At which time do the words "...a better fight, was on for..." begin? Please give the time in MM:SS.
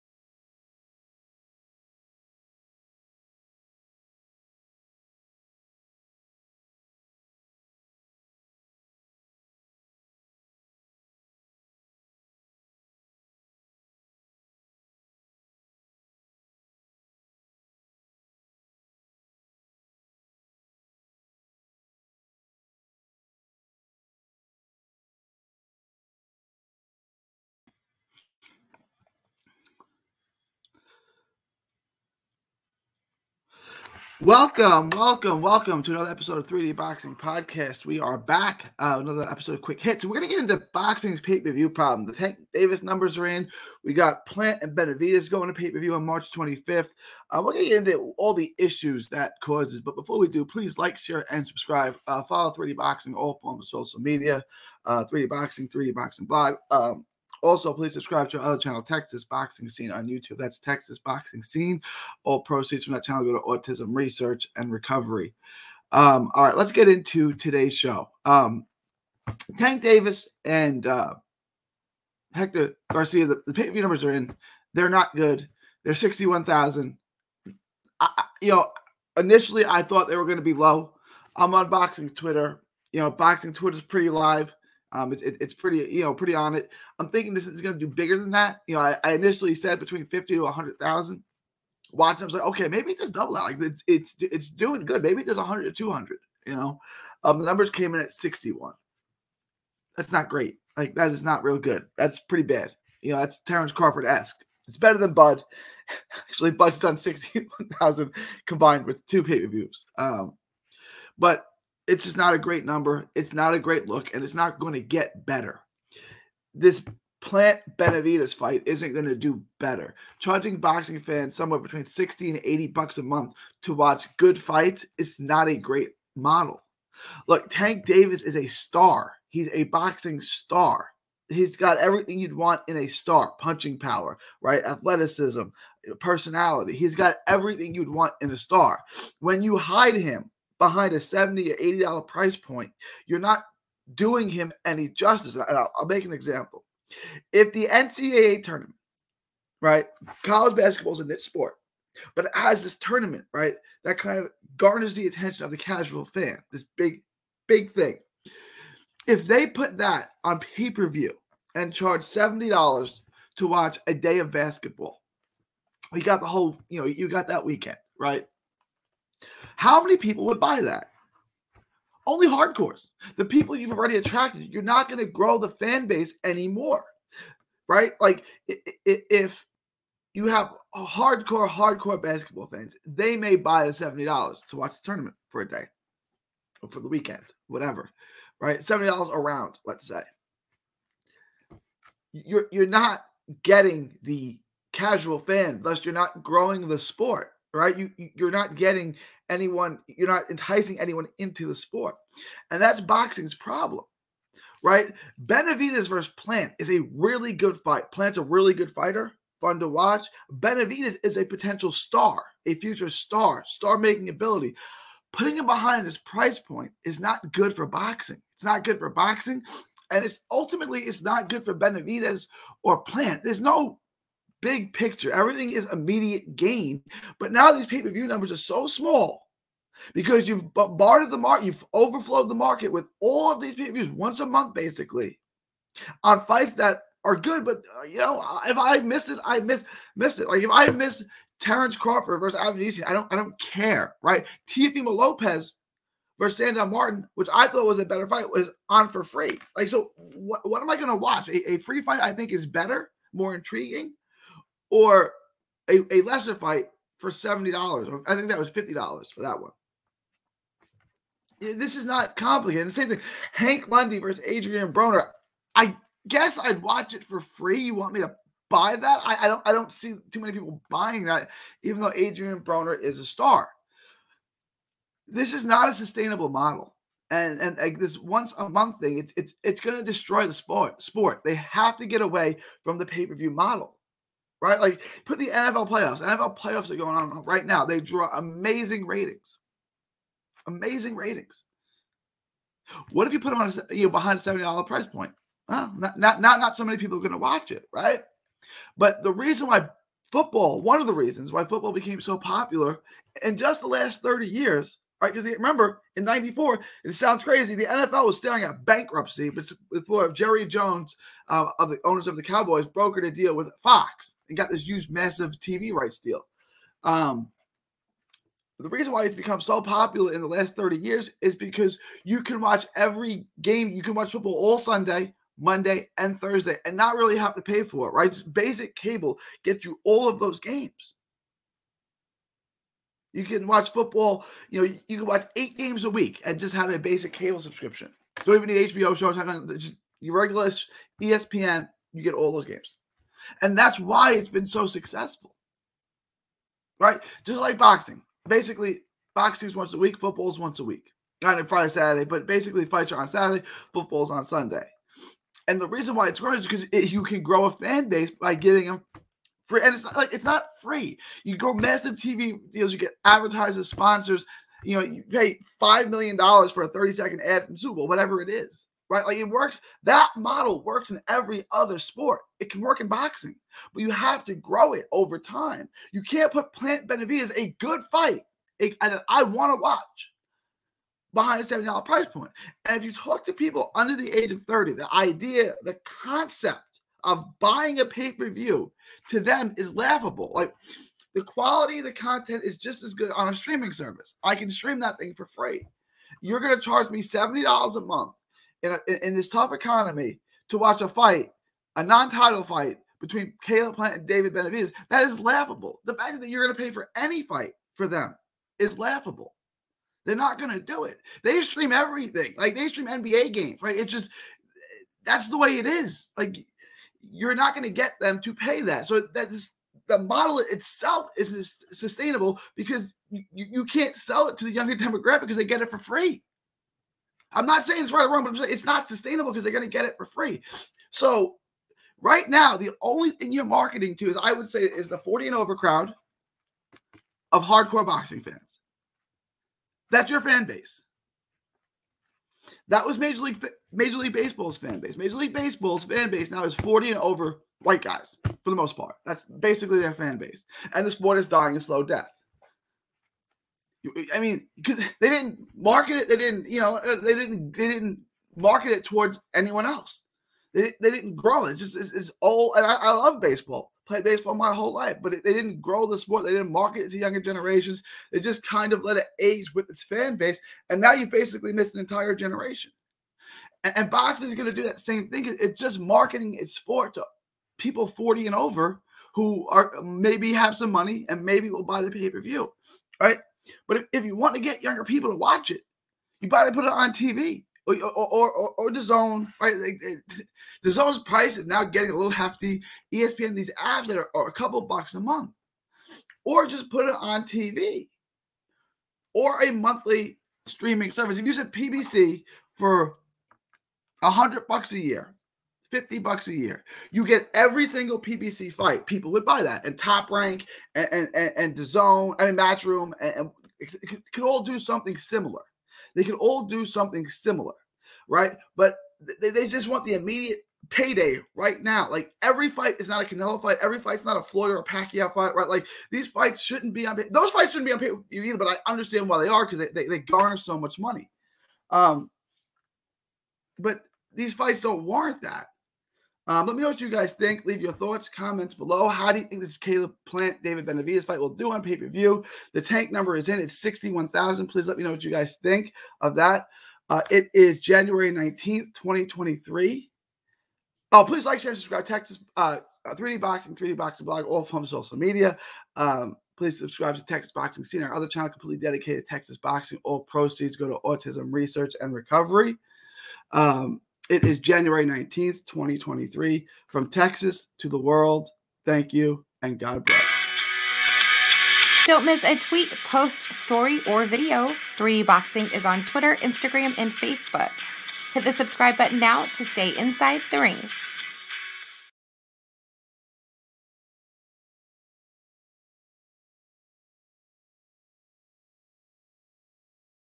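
04:07.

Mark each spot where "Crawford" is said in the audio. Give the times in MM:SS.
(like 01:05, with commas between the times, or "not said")
01:43, 04:01.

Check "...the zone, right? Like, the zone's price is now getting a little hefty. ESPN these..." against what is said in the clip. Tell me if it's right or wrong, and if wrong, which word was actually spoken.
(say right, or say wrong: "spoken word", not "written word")
right.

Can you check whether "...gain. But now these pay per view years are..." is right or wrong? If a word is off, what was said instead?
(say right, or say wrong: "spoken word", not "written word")
wrong: "numbers", not "years".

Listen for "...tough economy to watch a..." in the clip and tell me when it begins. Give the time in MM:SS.
06:39.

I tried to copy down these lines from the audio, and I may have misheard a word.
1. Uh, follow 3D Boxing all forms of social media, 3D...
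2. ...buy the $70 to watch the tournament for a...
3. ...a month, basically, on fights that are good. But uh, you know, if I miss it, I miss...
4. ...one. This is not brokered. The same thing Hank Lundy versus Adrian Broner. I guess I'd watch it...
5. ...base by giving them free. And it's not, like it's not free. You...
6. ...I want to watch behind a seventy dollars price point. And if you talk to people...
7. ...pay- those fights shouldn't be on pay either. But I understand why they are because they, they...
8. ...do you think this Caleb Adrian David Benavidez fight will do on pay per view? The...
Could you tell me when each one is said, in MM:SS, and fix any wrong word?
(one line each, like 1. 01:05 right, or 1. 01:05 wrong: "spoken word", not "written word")
1. 00:52 right
2. 03:03 right
3. 03:54 right
4. 04:19 wrong: "complicated", not "brokered"
5. 05:57 right
6. 06:19 right
7. 08:46 right
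8. 08:59 wrong: "Plant", not "Adrian".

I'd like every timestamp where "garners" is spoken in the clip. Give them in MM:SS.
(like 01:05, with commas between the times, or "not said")
02:34, 08:49.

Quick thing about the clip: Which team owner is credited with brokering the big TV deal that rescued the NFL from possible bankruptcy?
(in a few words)
Jerry Jones.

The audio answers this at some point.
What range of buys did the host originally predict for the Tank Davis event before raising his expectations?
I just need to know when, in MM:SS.
01:29.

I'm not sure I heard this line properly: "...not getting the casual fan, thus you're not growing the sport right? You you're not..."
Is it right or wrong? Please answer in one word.
right.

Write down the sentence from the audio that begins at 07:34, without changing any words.
I mean, they didn't market it.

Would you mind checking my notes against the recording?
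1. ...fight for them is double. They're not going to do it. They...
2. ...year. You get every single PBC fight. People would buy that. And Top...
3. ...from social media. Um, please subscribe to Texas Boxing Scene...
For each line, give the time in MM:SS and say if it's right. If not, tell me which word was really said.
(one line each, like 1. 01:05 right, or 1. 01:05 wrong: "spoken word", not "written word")
1. 06:47 wrong: "laughable", not "double"
2. 08:26 right
3. 09:14 right.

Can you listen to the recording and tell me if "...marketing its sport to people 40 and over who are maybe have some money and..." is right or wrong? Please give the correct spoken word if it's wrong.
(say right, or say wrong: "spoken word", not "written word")
right.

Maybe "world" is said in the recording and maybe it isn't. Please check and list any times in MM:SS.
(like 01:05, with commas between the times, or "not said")
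09:27.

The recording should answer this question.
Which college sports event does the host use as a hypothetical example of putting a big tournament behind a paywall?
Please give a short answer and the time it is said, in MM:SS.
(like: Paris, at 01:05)
NCAA tournament, at 02:27.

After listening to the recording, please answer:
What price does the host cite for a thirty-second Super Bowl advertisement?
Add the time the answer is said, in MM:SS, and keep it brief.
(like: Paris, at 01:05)
$5 million, at 06:05.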